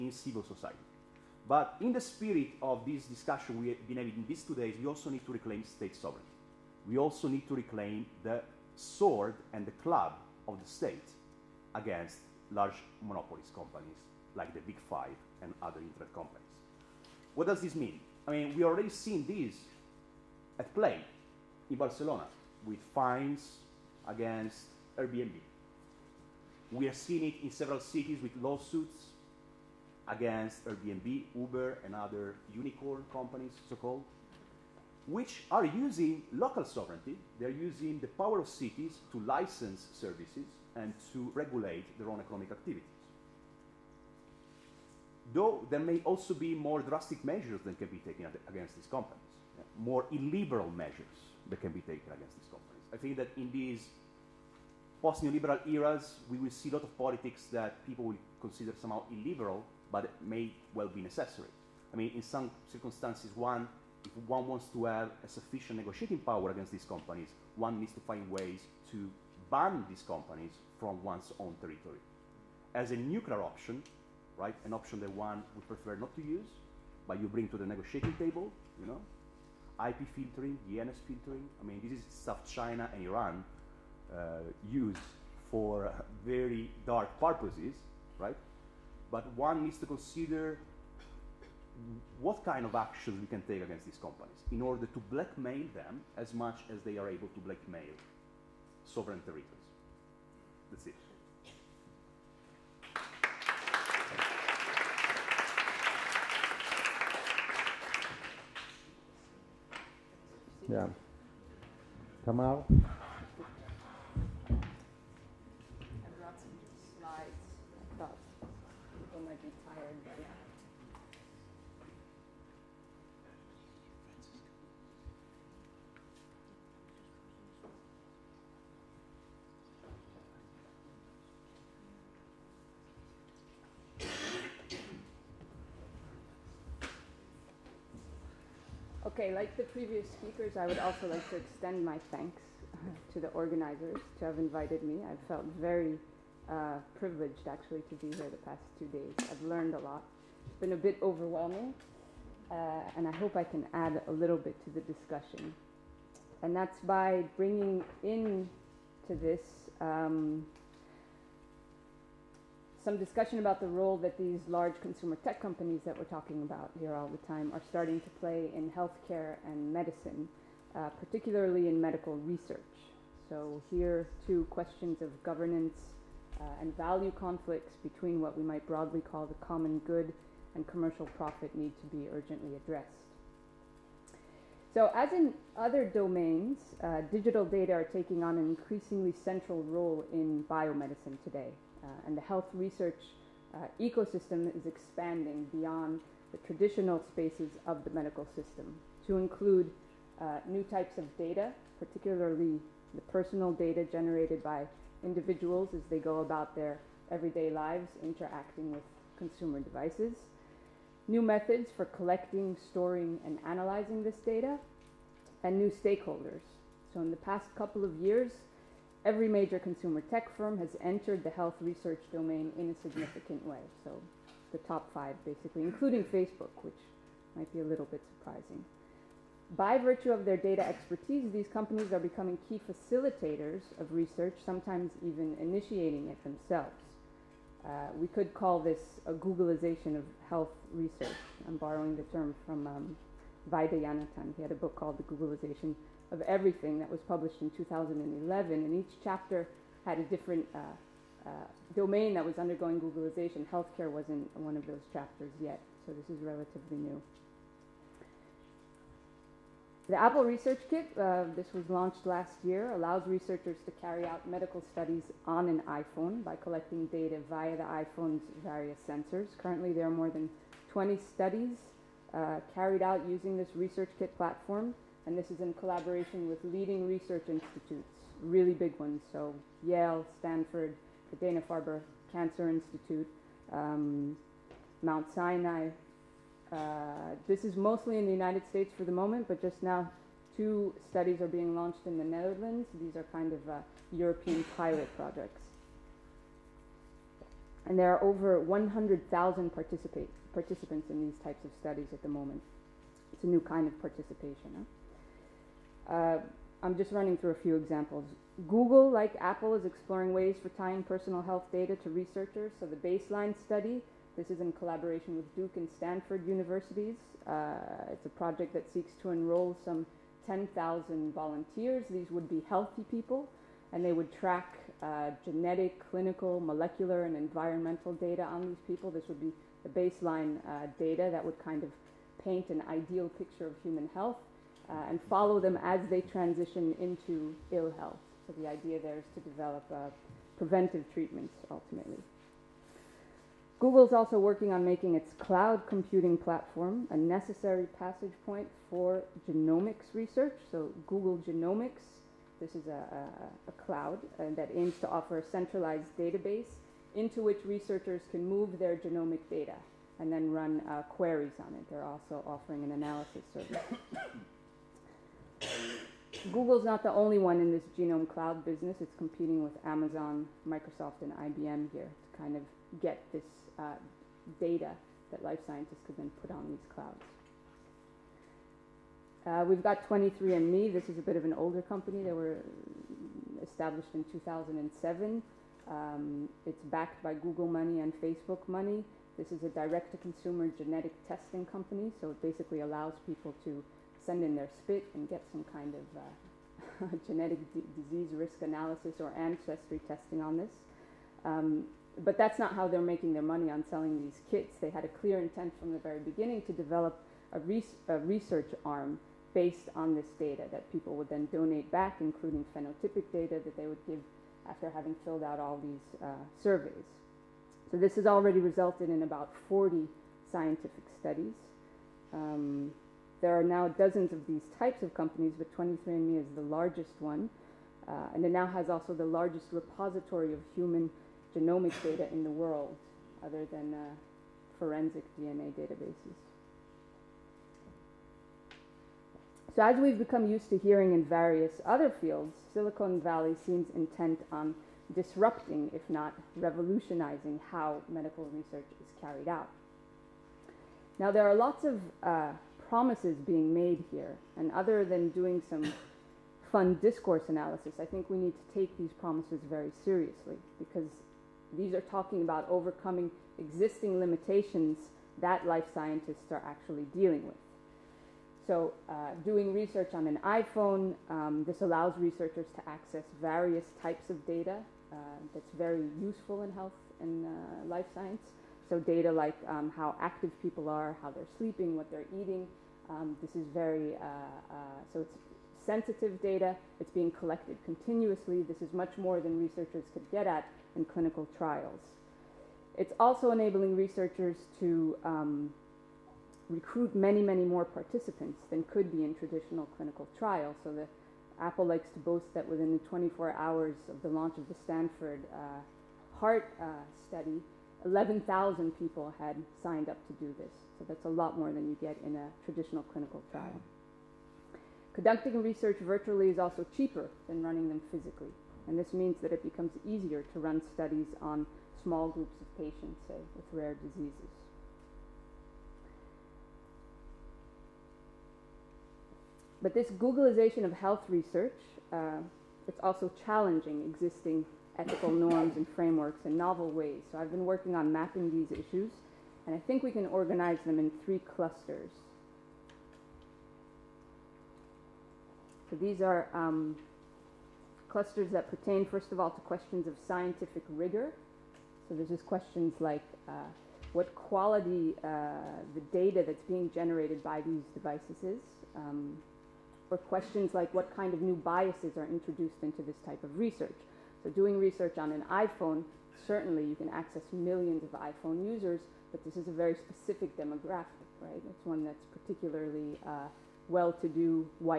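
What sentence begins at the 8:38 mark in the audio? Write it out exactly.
And this means that it becomes easier to run studies on small groups of patients, say, with rare diseases.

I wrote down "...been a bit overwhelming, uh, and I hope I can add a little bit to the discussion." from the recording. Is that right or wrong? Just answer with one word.
right.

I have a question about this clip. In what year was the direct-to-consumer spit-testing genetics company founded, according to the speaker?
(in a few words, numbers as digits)
2007.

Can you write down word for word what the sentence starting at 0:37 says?
They're using the power of cities to license services and to regulate their own economic activities.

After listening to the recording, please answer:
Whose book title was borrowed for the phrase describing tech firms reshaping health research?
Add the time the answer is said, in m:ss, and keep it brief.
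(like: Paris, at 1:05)
Vaidhyanathan, at 4:03.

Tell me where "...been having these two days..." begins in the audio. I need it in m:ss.
0:03.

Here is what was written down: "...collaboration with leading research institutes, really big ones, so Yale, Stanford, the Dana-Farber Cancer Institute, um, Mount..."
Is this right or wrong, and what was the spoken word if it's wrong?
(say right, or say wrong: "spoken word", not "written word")
right.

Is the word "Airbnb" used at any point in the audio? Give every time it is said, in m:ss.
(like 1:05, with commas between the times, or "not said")
0:24, 0:30.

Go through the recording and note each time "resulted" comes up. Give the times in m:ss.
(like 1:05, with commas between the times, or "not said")
6:58.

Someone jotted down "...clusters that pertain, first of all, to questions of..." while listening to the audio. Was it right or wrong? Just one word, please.
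right.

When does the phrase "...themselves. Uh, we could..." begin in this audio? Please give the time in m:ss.
3:56.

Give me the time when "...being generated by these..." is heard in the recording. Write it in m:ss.
9:16.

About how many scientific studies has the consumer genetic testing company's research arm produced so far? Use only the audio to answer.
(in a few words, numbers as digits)
40.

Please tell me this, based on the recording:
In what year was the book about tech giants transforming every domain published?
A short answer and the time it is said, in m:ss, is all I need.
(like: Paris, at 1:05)
2011, at 4:07.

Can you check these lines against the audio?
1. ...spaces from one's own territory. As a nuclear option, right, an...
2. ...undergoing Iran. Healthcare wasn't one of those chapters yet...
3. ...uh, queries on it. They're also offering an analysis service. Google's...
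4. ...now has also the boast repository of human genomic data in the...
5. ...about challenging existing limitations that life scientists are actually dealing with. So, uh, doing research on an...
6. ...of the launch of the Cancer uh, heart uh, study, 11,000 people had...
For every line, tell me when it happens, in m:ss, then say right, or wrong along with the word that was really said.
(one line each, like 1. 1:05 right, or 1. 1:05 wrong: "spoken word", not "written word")
1. 1:10 wrong: "companies", not "spaces"
2. 4:12 wrong: "Googleization", not "Iran"
3. 6:00 right
4. 7:08 wrong: "largest", not "boast"
5. 7:42 wrong: "overcoming", not "challenging"
6. 8:23 wrong: "Stanford", not "Cancer".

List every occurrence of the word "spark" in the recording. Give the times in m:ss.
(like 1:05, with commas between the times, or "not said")
not said.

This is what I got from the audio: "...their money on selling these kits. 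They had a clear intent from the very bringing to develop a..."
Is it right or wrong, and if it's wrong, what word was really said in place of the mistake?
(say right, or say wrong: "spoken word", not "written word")
wrong: "beginning", not "bringing".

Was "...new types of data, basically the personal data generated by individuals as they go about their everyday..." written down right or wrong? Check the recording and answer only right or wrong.
wrong.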